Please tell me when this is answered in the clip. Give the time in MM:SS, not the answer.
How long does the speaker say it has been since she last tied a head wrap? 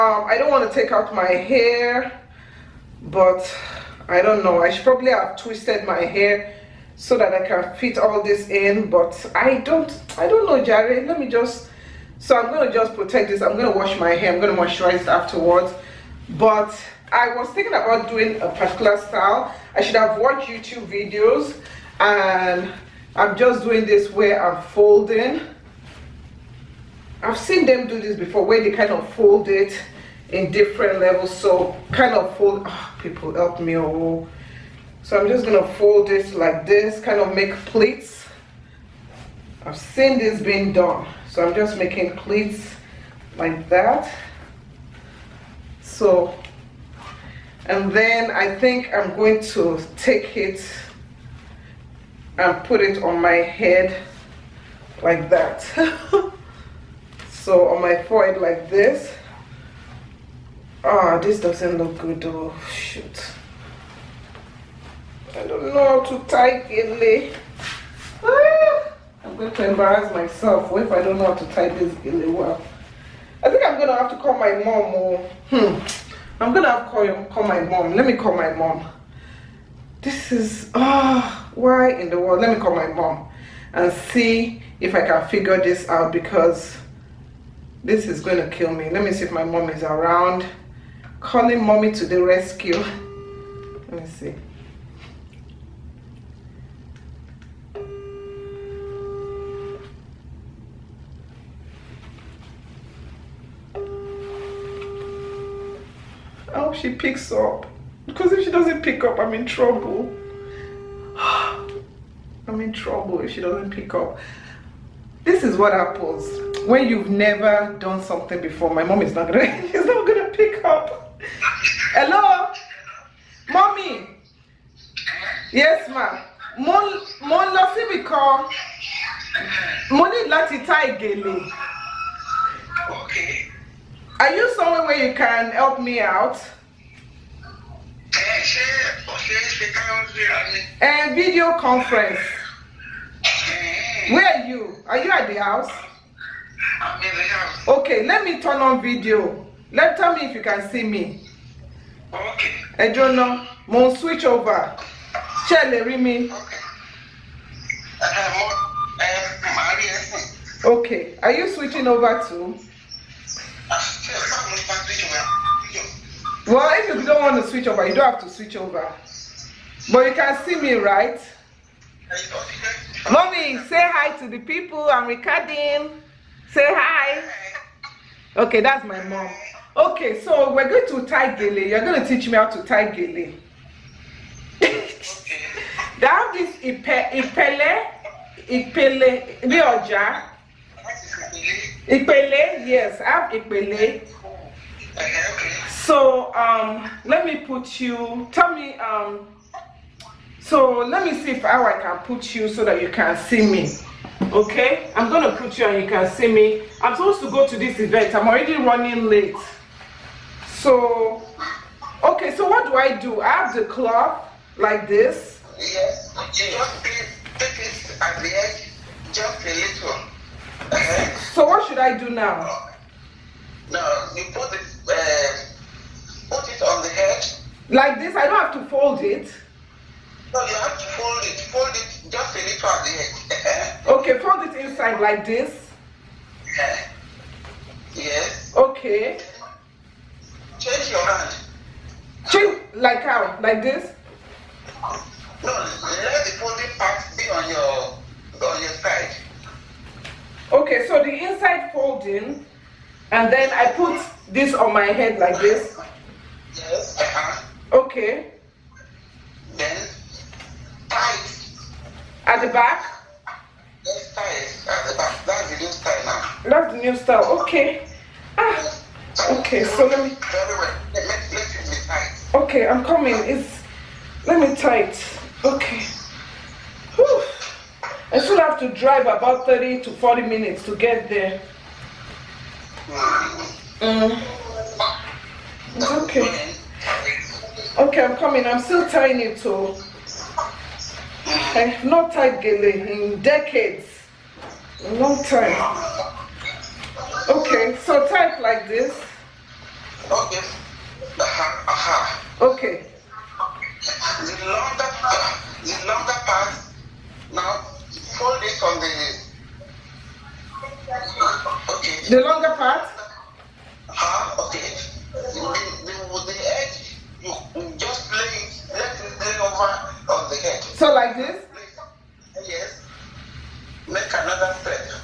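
04:53.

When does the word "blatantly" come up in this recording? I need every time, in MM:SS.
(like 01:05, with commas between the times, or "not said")
not said.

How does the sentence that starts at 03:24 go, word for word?
Okay, I'm gonna put you and you can see me.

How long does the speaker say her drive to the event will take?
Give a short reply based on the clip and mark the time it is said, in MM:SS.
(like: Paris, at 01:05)
30 to 40 minutes, at 04:39.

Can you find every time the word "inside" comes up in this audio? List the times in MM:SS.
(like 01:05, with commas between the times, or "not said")
03:54, 04:11.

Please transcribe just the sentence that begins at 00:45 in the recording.
So, and then I think I'm going to take it and put it on my head like that.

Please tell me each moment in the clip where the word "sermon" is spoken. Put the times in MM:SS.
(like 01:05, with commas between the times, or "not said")
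not said.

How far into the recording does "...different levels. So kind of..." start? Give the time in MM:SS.
00:30.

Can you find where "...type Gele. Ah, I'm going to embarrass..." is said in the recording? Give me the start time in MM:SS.
01:06.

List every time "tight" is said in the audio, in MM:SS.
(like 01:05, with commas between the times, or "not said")
04:24, 04:34.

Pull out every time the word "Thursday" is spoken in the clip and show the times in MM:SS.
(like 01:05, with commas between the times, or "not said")
not said.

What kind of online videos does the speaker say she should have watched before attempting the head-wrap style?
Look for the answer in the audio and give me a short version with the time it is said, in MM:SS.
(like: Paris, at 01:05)
YouTube videos, at 00:20.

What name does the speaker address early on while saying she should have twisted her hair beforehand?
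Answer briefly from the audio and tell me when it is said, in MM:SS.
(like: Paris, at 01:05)
Jared, at 00:10.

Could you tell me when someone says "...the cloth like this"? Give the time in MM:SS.
03:33.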